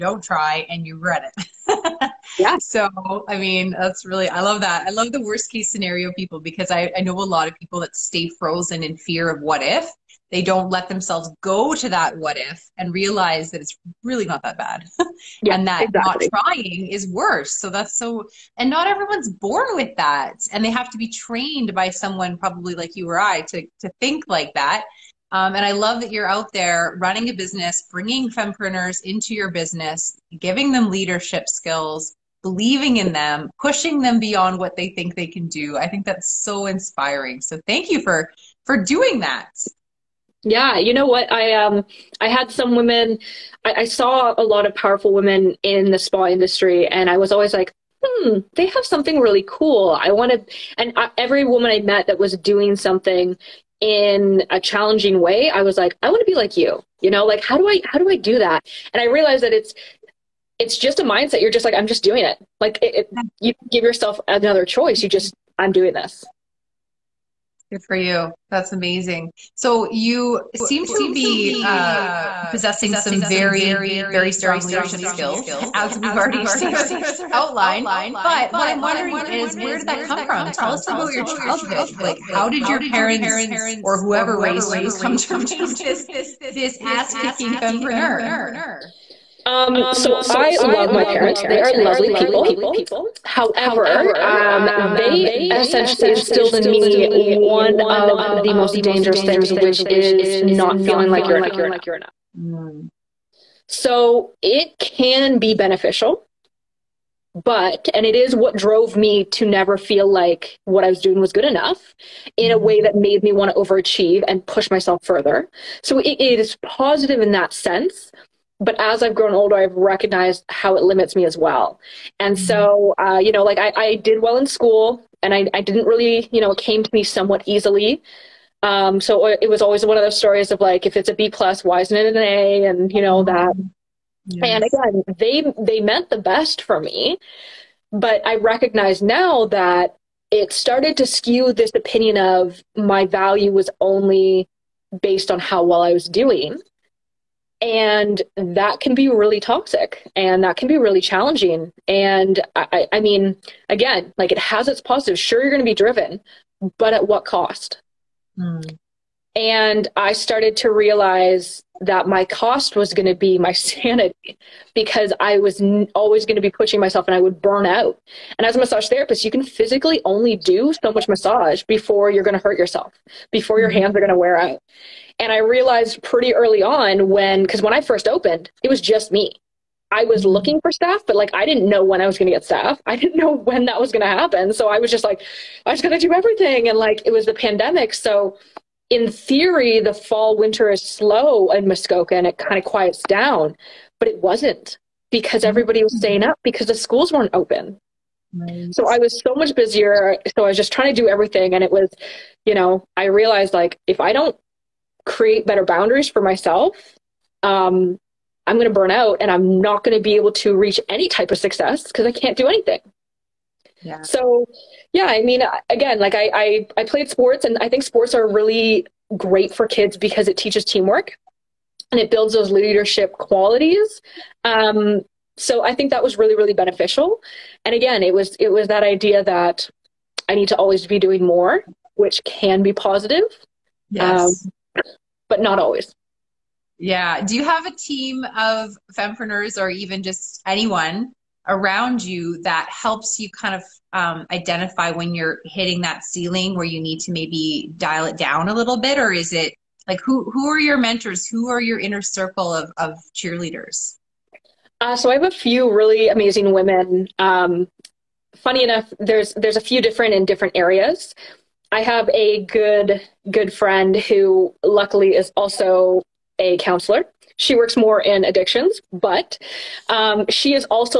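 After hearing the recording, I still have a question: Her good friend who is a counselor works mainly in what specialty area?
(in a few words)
addictions.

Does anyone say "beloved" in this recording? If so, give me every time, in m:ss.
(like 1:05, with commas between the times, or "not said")
not said.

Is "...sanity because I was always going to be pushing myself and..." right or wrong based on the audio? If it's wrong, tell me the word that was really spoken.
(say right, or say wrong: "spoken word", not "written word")
right.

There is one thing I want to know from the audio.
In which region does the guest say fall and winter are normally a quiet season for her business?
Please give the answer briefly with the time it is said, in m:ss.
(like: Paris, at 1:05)
Muskoka, at 3:11.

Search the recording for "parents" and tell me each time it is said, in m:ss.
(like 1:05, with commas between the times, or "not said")
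1:22, 1:31.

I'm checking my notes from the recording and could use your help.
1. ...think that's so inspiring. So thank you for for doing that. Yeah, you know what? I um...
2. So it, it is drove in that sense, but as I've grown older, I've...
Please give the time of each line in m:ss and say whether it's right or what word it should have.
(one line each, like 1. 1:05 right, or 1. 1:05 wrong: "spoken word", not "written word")
1. 0:35 right
2. 1:55 wrong: "positive", not "drove".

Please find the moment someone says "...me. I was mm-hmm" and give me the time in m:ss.
2:59.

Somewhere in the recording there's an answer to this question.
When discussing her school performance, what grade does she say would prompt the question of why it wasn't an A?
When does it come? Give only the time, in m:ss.
2:11.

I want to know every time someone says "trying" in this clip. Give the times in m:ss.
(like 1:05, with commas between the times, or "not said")
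0:16, 3:20.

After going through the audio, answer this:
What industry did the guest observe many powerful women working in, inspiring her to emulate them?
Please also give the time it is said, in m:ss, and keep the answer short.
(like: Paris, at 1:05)
spa industry, at 0:45.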